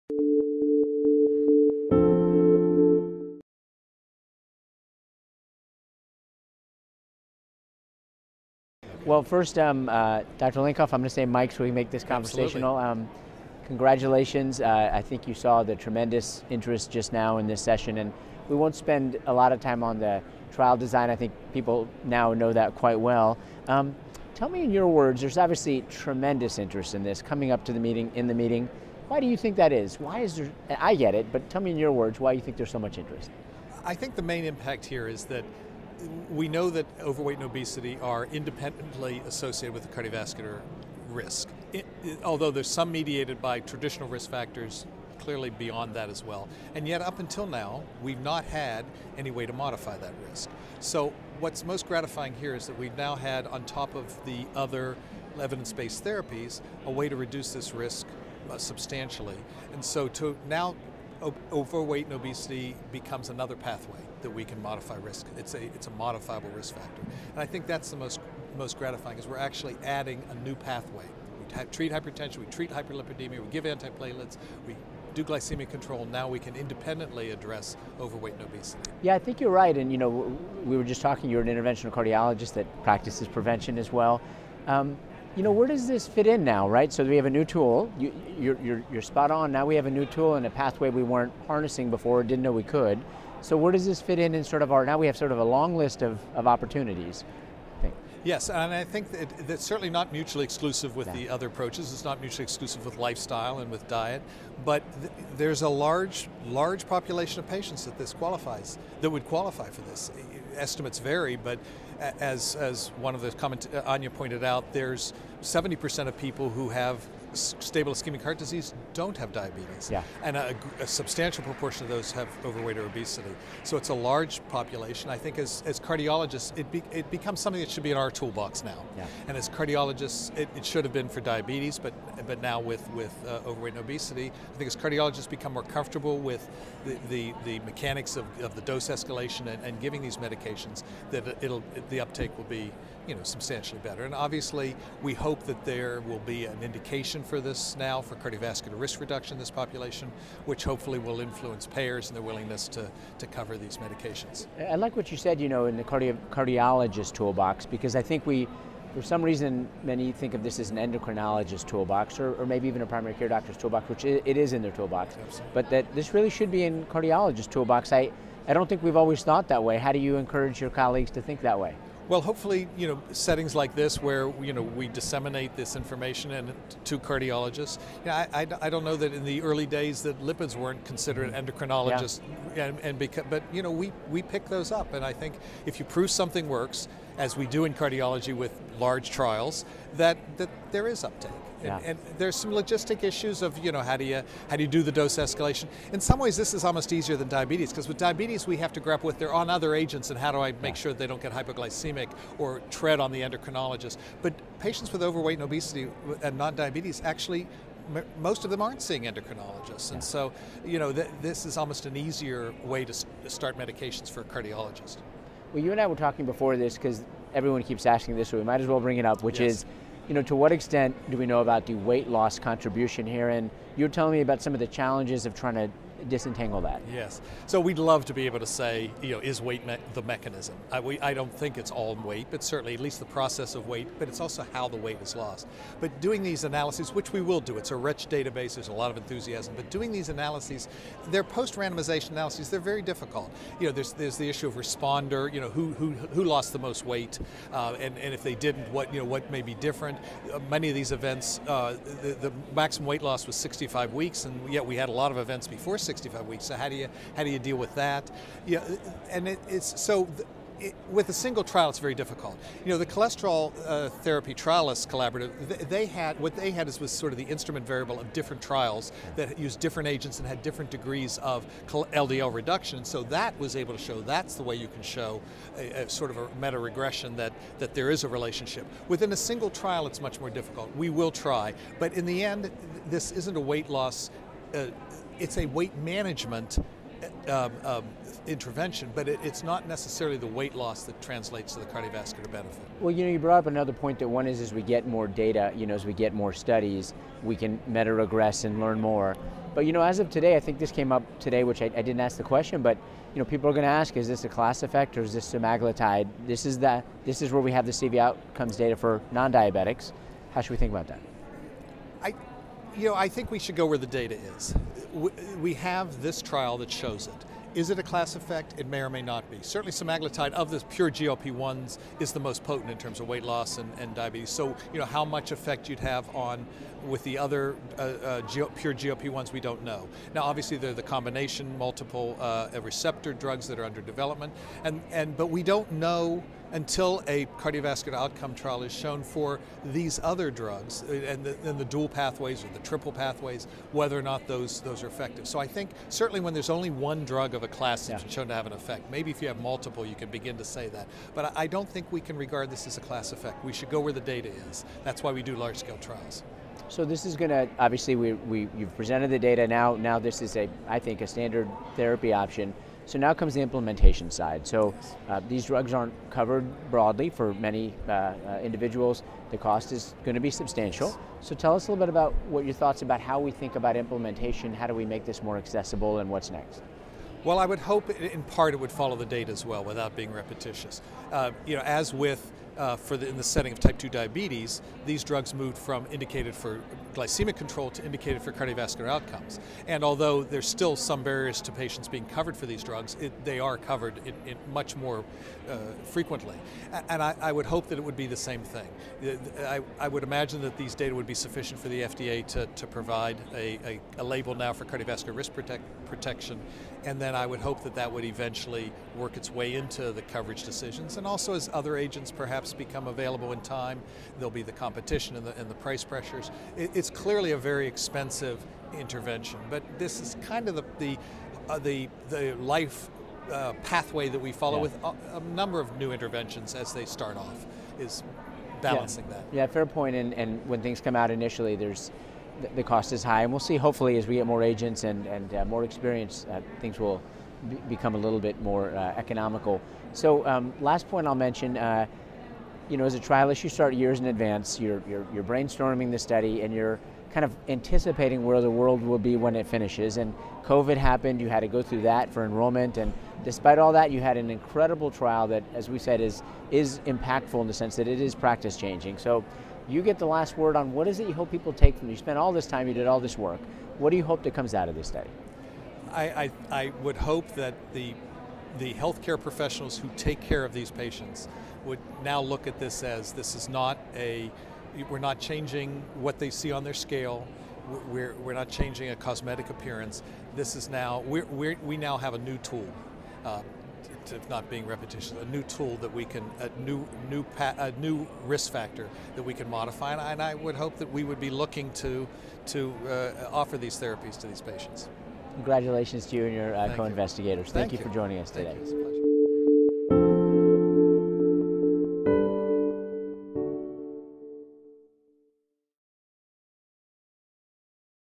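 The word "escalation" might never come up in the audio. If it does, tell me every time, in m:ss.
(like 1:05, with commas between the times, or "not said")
2:18, 3:15.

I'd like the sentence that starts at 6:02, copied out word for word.
So now comes the implementation side.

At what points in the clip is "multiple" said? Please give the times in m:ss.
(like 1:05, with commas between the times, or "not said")
5:31, 5:49.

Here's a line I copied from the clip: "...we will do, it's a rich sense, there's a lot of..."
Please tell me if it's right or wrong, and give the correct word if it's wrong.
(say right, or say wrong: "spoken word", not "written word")
wrong: "database", not "sense".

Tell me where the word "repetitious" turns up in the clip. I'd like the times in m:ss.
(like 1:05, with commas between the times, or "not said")
6:20, 8:04.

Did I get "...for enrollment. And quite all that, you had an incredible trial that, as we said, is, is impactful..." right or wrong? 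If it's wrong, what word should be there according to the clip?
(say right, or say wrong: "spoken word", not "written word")
wrong: "despite", not "quite".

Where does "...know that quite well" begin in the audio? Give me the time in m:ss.
0:22.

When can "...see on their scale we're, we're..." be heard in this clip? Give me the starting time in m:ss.
7:56.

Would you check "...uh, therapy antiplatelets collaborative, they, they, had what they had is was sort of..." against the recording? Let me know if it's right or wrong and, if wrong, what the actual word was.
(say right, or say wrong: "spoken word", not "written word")
wrong: "trialists", not "antiplatelets".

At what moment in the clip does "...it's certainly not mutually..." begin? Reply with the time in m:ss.
1:39.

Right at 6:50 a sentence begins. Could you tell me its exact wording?
And also, as other agents perhaps become available in time, there'll be the competition and the, and the price pressures.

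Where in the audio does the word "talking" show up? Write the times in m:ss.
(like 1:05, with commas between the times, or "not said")
1:21, 3:35.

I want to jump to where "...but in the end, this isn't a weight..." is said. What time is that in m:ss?
4:41.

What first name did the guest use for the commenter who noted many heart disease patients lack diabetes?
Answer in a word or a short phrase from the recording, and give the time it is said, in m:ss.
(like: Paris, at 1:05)
Anya, at 1:53.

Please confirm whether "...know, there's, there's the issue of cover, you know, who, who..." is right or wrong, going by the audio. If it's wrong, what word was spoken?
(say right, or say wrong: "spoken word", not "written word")
wrong: "responder", not "cover".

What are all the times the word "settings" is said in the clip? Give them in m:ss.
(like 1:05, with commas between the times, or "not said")
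2:53, 6:23.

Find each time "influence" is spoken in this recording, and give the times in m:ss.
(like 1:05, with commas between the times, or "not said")
2:31.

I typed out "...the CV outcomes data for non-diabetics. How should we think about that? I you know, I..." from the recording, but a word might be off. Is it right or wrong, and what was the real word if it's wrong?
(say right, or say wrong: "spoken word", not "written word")
right.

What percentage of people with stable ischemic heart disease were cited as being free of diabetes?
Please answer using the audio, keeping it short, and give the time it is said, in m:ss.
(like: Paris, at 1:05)
70%, at 1:55.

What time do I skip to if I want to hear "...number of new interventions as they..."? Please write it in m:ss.
7:05.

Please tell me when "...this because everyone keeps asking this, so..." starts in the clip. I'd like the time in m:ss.
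3:36.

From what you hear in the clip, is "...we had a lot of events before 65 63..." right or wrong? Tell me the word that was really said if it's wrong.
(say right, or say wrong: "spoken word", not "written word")
wrong: "65", not "63".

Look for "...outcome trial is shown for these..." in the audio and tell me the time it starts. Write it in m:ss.
5:37.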